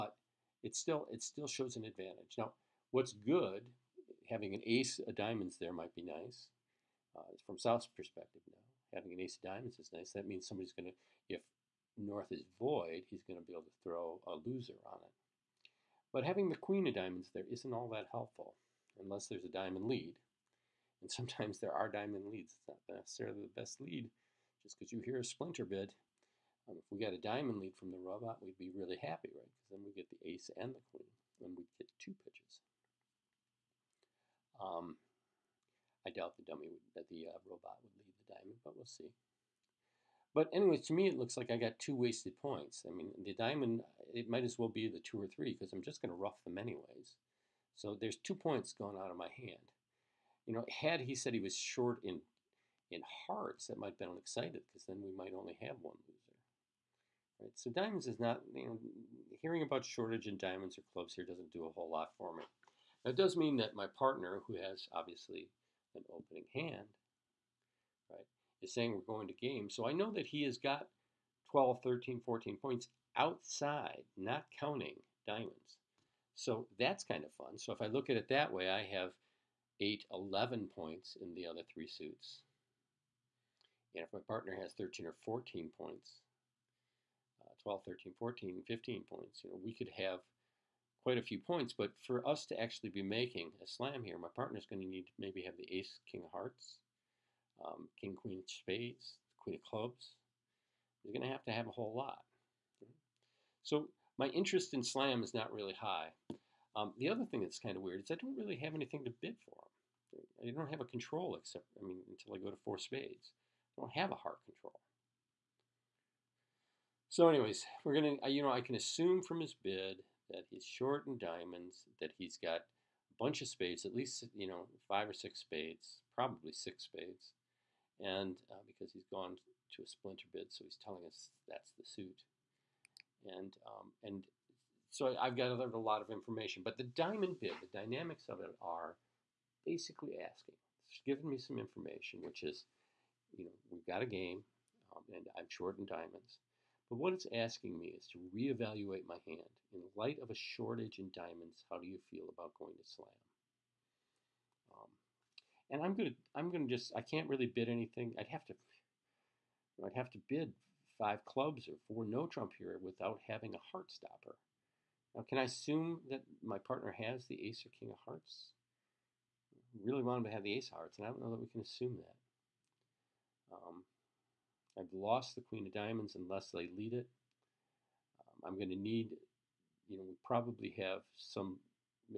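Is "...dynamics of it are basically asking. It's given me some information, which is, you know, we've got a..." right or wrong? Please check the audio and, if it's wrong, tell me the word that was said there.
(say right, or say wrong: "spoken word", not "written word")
right.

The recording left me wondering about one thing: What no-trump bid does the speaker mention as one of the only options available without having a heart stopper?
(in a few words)
4 no trump.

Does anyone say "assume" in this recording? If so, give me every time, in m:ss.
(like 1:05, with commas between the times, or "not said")
1:58, 2:45, 2:51.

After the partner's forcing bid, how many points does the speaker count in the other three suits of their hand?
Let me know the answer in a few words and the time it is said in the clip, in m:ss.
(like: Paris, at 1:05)
11, at 1:20.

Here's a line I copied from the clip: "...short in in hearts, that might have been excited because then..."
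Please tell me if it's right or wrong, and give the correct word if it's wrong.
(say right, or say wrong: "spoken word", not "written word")
right.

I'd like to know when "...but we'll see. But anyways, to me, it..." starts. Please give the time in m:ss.
0:38.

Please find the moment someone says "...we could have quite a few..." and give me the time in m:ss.
1:29.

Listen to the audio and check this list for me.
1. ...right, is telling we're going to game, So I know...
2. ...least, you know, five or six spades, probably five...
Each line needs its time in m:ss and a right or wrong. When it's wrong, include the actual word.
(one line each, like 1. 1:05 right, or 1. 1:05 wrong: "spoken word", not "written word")
1. 1:08 wrong: "saying", not "telling"
2. 2:03 wrong: "six", not "five".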